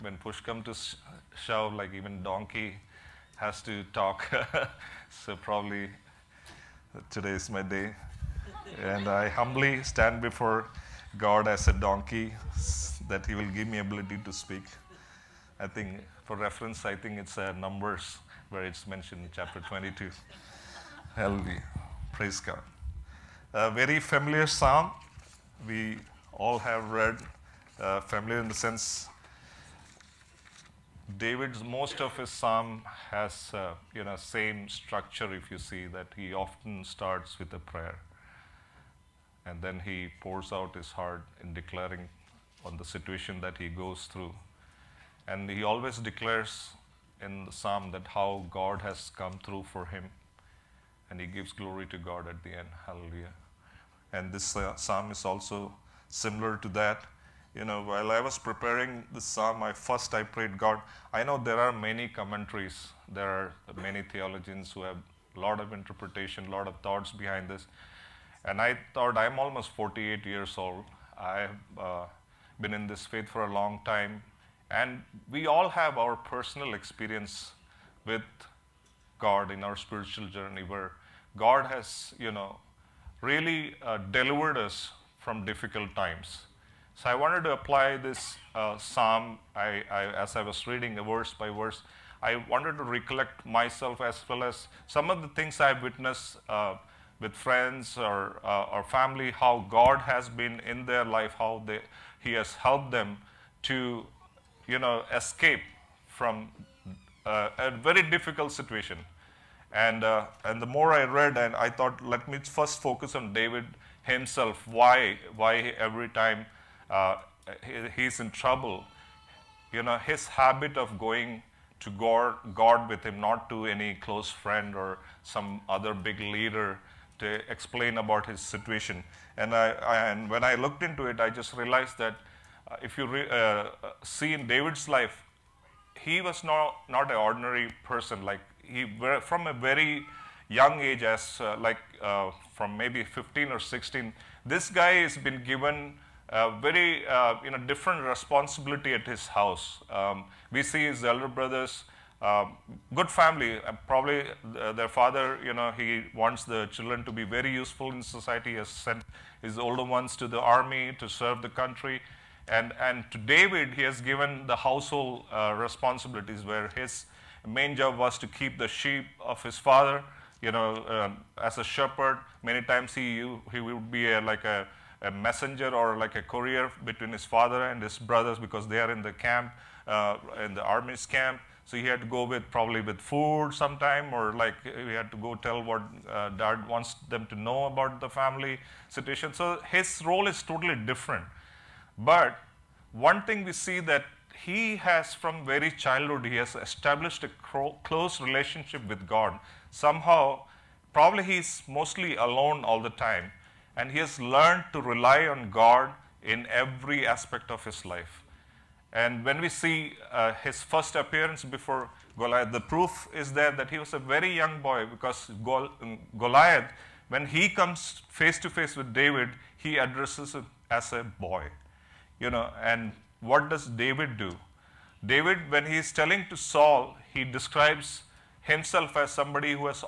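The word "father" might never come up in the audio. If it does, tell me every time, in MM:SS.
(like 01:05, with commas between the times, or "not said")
02:34, 02:49, 02:57.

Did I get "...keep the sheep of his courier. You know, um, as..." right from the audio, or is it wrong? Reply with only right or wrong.
wrong.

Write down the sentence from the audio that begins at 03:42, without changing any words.
You know, and what does David do?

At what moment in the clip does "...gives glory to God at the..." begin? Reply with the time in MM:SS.
00:51.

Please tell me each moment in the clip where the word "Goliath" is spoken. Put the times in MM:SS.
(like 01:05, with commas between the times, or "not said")
03:32, 03:36.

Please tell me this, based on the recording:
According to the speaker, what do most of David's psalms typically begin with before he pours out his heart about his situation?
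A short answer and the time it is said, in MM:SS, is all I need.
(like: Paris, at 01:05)
a prayer, at 00:37.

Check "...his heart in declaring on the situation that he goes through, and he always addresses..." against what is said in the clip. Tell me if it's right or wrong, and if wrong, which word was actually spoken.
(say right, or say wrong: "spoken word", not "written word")
wrong: "declares", not "addresses".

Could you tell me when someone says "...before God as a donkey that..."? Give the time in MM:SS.
00:10.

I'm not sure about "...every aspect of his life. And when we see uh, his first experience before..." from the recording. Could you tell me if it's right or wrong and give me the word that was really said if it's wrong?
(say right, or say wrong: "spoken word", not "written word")
wrong: "appearance", not "experience".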